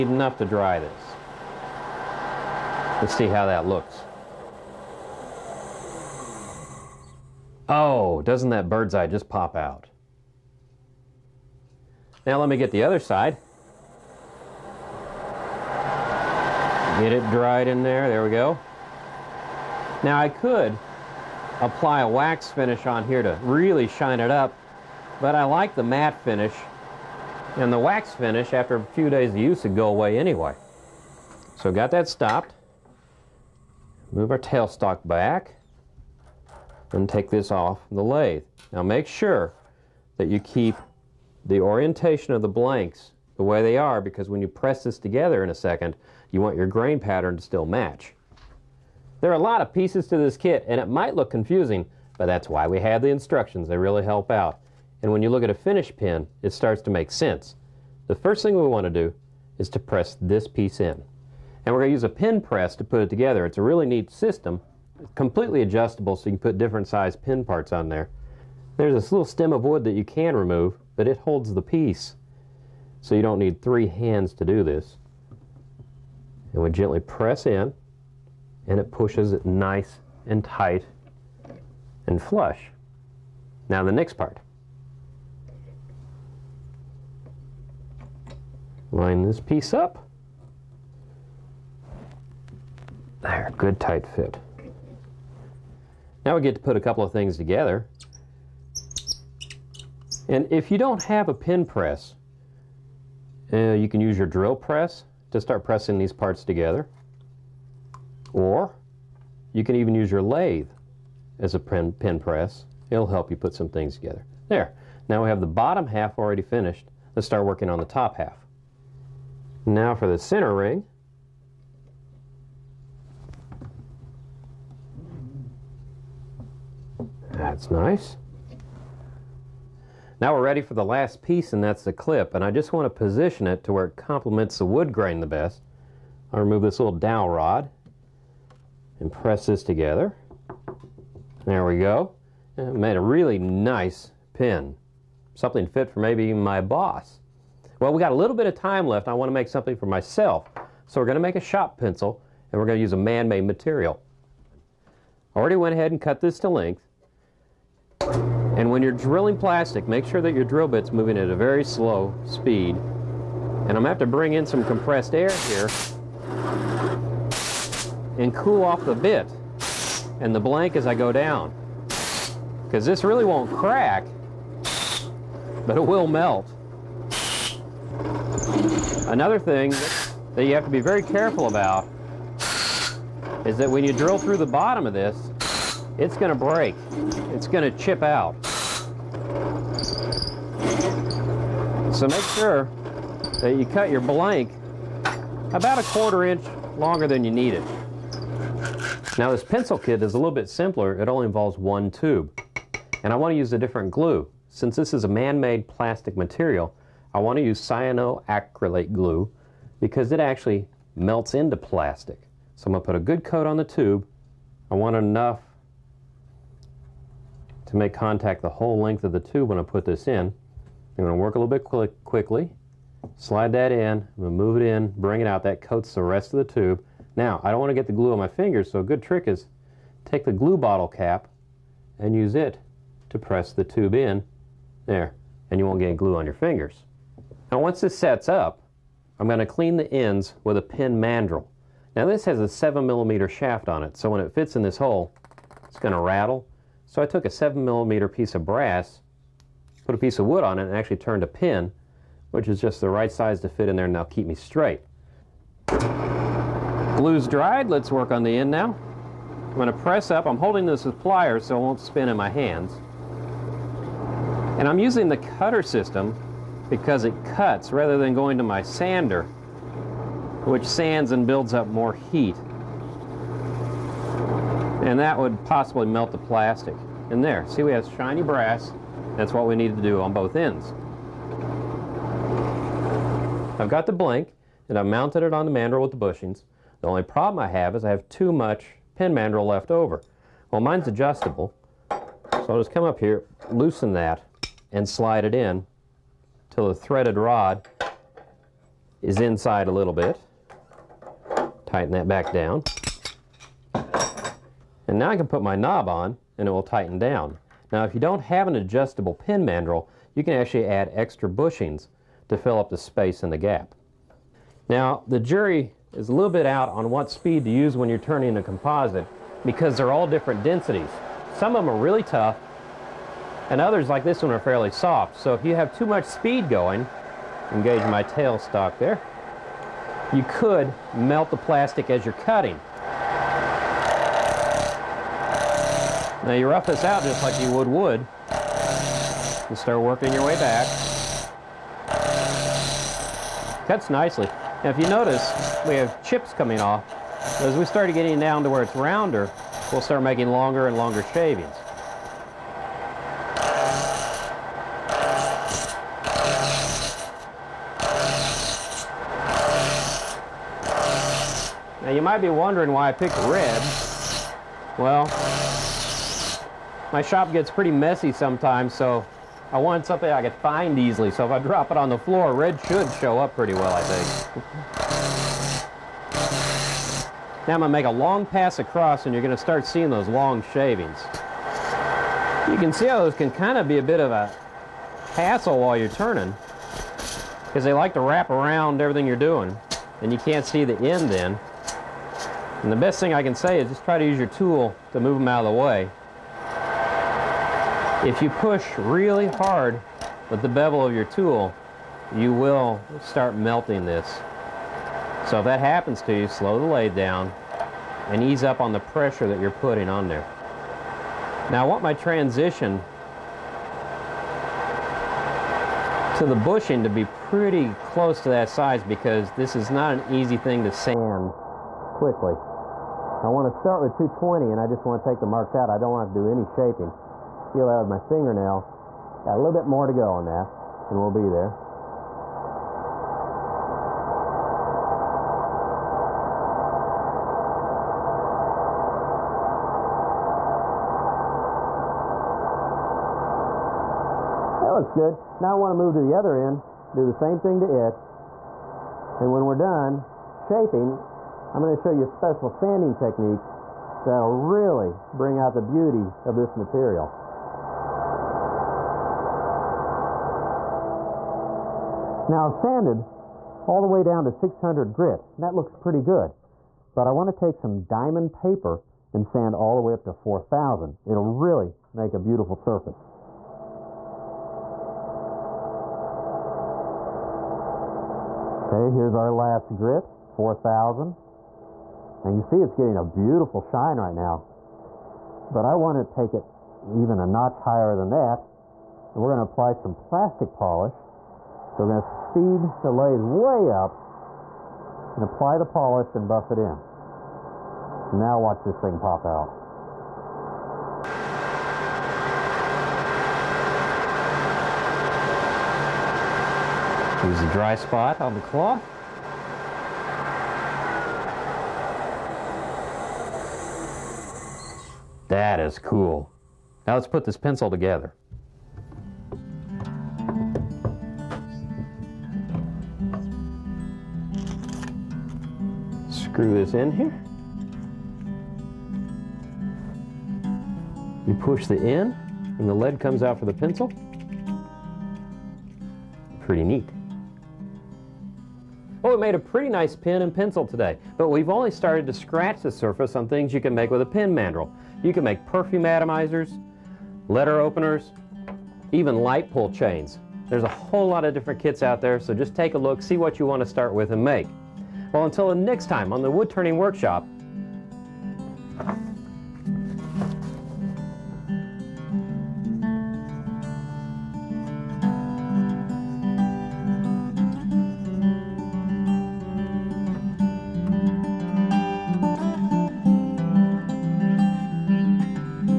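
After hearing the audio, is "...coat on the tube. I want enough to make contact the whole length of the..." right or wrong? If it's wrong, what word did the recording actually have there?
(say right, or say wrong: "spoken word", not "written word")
right.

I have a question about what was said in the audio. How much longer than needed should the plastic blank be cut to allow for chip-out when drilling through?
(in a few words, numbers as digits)
A quarter inch.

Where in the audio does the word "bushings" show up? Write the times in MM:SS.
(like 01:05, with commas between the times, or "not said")
04:45, 05:11, 06:56.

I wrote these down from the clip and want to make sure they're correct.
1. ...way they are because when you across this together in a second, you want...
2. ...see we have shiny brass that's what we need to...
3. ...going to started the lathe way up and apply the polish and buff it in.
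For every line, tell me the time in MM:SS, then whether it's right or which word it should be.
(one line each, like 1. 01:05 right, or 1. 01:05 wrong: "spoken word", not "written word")
1. 00:43 wrong: "press", not "across"
2. 04:37 right
3. 08:11 wrong: "speed", not "started".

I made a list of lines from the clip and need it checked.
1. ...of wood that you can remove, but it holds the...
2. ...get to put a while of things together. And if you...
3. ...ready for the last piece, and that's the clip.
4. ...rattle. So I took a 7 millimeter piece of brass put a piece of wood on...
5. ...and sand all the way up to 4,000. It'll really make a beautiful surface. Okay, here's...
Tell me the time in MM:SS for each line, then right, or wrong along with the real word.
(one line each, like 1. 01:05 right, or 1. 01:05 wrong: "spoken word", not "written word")
1. 01:09 right
2. 01:36 wrong: "couple", not "while"
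3. 02:10 right
4. 04:06 right
5. 07:49 right.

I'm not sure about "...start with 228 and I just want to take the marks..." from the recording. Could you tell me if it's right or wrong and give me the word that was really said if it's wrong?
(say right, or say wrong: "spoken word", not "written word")
wrong: "220", not "228".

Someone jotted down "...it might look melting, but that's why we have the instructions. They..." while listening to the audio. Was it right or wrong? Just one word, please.
wrong.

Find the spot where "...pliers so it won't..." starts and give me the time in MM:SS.
04:21.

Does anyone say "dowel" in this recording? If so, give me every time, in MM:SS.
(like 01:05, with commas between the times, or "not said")
02:16.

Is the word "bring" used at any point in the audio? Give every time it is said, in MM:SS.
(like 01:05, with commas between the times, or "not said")
02:44, 03:44, 07:35.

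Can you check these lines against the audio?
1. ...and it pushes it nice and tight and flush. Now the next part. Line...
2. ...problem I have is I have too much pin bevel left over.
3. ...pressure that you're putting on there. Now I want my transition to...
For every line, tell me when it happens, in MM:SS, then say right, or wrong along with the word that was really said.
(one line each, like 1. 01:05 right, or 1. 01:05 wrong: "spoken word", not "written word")
1. 01:18 right
2. 04:47 wrong: "mandrel", not "bevel"
3. 06:48 right.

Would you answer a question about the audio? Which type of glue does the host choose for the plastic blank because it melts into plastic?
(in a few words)
Cyanoacrylate glue.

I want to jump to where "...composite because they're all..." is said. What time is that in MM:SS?
05:18.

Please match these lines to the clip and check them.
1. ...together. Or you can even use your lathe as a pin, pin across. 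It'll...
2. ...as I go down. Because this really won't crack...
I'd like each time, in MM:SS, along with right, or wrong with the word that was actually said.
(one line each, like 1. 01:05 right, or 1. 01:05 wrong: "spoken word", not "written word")
1. 01:46 wrong: "press", not "across"
2. 02:50 right.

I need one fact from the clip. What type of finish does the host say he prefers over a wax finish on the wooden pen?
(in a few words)
Matte finish.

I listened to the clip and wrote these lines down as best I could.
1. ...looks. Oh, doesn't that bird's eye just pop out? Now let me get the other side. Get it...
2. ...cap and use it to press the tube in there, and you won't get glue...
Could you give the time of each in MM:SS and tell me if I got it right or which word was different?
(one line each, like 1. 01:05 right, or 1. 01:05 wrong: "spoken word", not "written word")
1. 00:03 right
2. 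03:50 right.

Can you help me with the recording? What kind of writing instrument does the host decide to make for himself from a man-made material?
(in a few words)
Shop pencil.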